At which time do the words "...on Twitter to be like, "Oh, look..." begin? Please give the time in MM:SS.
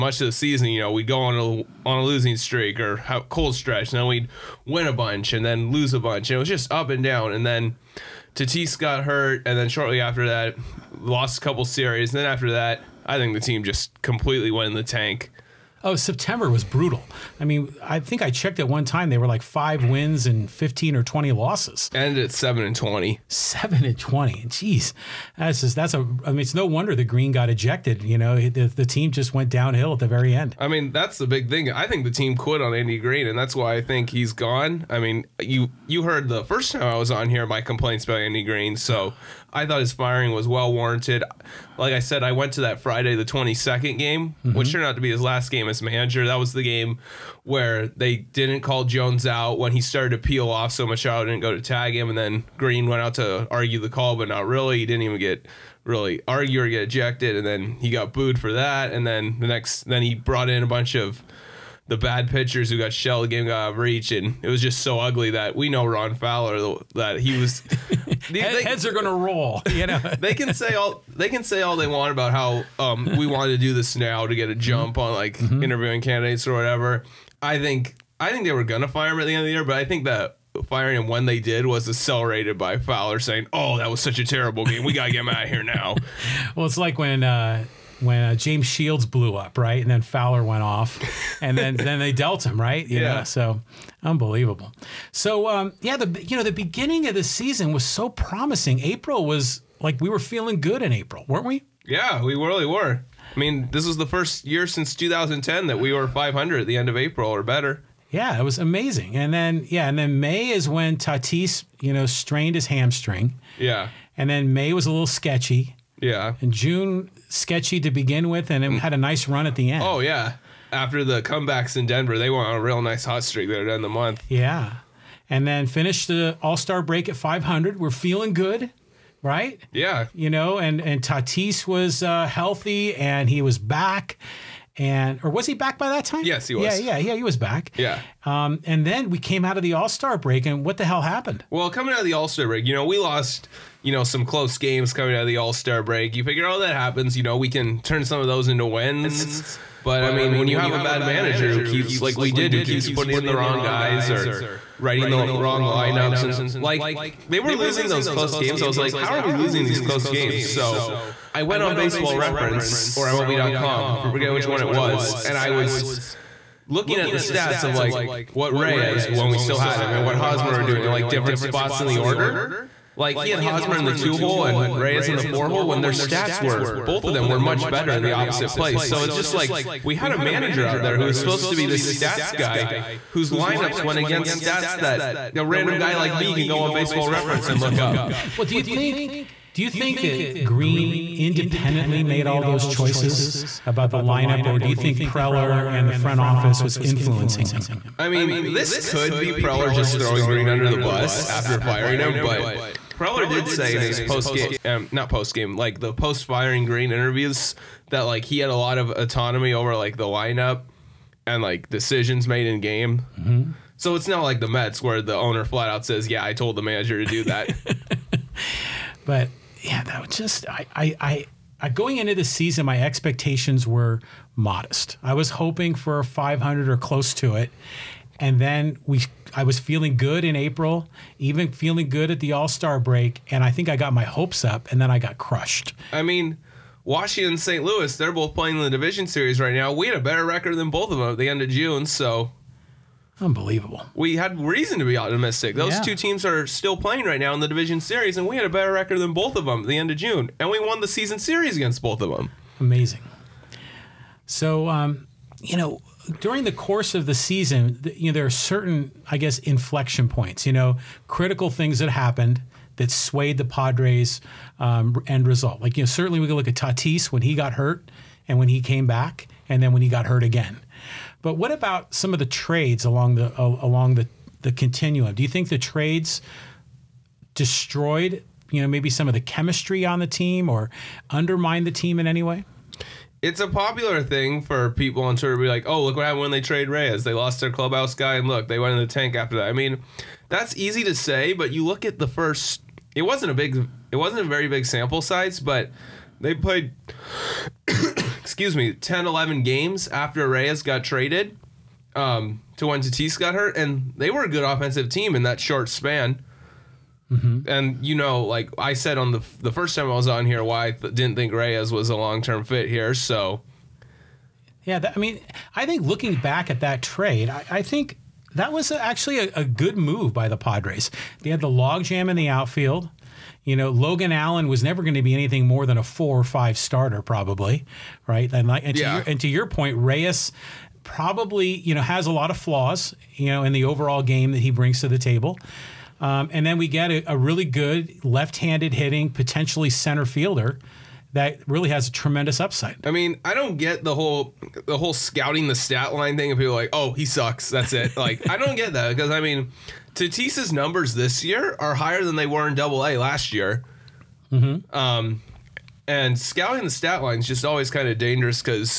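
04:45.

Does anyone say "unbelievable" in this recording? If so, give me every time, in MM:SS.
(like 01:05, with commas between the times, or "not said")
01:34, 04:03.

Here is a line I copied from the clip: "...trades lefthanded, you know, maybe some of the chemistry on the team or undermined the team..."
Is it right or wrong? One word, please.
wrong.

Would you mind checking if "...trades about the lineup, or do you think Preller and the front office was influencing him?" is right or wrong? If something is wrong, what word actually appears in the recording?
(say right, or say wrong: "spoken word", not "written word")
wrong: "choices", not "trades".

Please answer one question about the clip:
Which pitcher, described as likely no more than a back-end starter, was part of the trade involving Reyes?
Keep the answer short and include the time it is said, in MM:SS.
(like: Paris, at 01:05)
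Logan Allen, at 05:23.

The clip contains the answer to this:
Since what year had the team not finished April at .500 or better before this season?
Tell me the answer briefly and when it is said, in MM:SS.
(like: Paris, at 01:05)
2010, at 01:44.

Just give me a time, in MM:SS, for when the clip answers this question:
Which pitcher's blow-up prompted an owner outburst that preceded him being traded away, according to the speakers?
01:28.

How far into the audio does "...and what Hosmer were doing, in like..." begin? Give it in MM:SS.
02:49.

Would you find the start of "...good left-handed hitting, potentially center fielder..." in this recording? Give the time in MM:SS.
05:37.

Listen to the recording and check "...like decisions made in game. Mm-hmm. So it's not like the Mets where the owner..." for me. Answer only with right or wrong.
right.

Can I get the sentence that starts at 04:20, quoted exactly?
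You know, critical things that happened that swayed the Padres' um, end result.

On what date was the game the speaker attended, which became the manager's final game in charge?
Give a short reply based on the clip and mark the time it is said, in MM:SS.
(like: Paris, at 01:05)
Friday the 22nd, at 00:42.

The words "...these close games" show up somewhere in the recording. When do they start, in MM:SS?
02:39.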